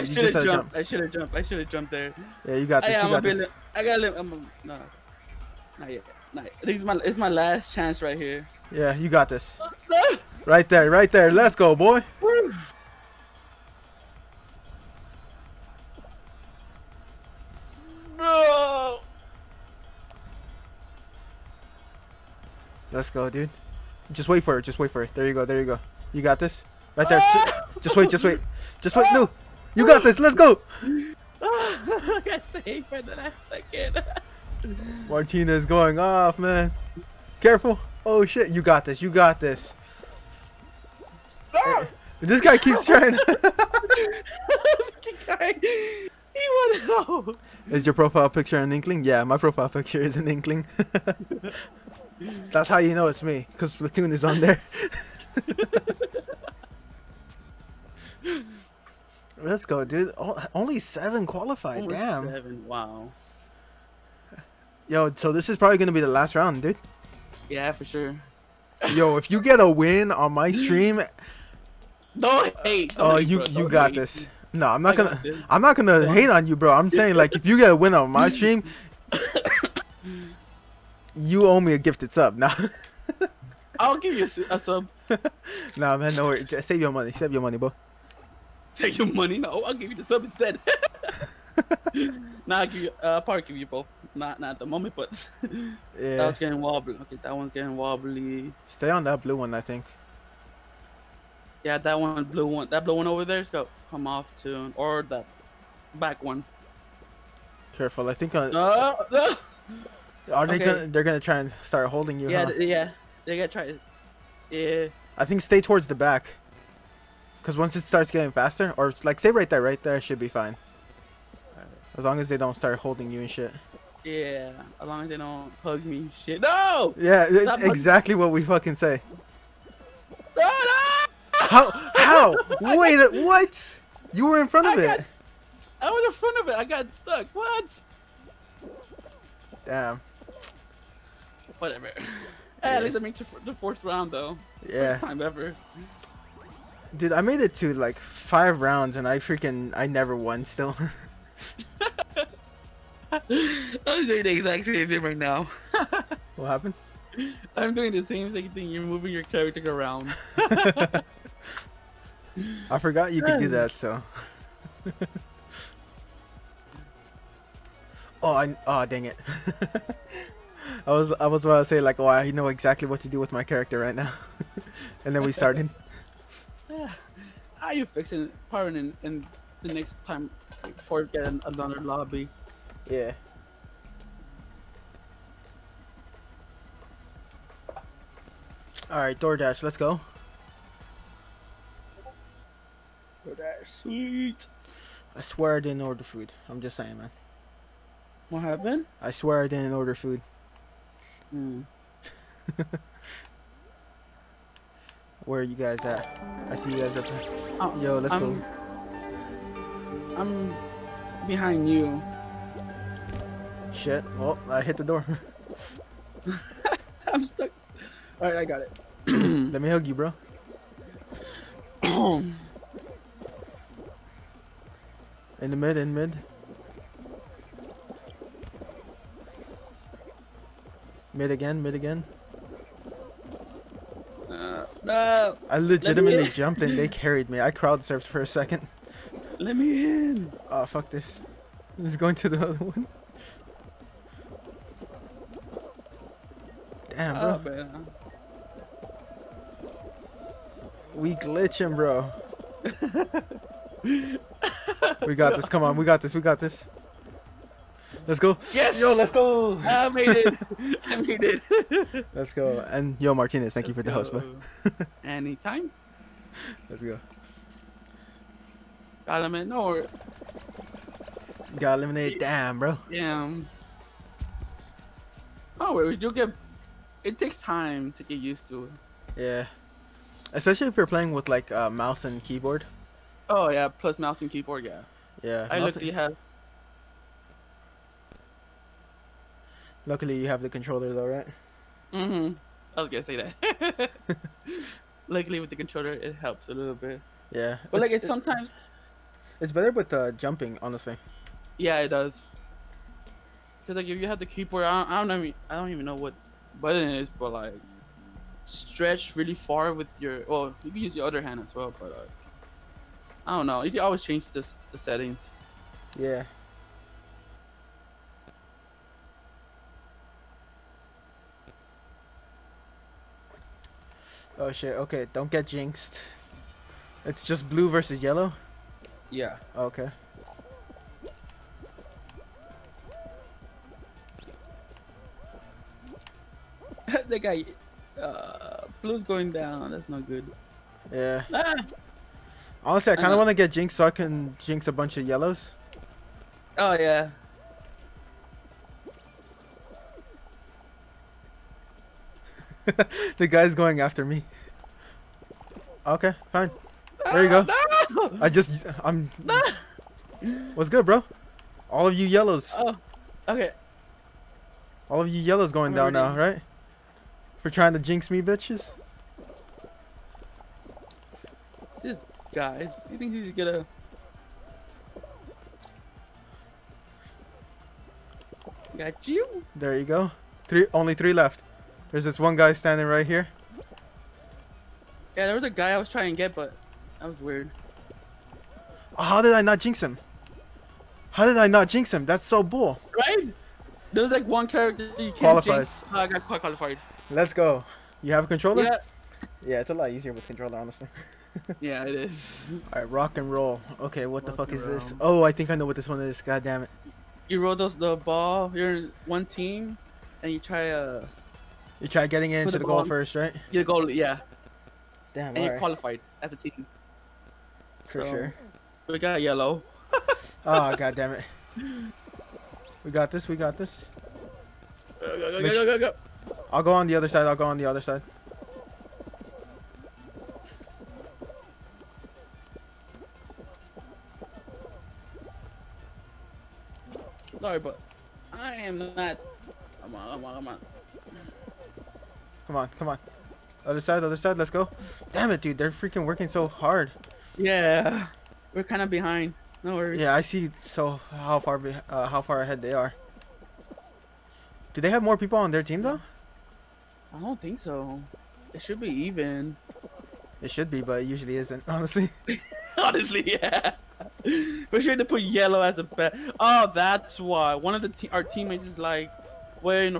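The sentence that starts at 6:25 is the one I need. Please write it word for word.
Yeah, there was a guy I was trying to get, but that was weird.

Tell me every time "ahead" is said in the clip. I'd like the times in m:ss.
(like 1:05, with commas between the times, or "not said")
7:32.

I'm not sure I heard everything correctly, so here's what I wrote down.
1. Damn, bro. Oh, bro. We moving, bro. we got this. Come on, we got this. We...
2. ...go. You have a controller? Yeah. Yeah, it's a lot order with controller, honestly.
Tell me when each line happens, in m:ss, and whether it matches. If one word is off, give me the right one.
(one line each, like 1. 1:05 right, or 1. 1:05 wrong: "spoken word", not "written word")
1. 4:06 wrong: "glitching", not "moving"
2. 6:37 wrong: "easier", not "order".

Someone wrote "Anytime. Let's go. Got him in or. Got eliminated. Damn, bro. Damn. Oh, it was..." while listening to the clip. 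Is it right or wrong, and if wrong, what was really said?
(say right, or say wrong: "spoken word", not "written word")
right.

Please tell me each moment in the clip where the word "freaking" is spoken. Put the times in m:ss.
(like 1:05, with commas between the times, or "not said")
2:29, 7:25.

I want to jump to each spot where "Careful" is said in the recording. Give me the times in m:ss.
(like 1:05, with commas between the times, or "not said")
0:37, 1:47.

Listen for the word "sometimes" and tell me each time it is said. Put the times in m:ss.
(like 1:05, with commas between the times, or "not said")
4:58.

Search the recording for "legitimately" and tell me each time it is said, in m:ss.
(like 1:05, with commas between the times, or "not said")
3:55.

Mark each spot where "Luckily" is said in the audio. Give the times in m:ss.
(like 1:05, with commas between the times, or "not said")
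4:49, 4:55.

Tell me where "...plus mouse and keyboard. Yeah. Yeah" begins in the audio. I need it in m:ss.
4:43.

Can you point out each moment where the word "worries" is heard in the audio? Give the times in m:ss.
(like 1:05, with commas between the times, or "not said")
1:26, 7:29.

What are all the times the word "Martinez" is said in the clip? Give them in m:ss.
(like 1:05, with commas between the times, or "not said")
0:35, 4:23.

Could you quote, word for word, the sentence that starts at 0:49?
Yeah, my profile picture is an inkling.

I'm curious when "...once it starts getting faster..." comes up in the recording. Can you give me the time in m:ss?
1:57.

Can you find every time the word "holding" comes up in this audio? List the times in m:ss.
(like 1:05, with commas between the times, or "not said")
1:51, 2:02.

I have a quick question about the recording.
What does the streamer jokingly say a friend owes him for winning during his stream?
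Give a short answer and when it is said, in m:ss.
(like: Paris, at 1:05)
A gifted sub, at 1:21.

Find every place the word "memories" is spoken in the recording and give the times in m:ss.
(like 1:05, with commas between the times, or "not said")
not said.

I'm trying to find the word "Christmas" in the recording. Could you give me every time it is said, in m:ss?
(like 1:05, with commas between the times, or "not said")
not said.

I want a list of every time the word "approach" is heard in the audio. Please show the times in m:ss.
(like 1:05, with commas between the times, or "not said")
not said.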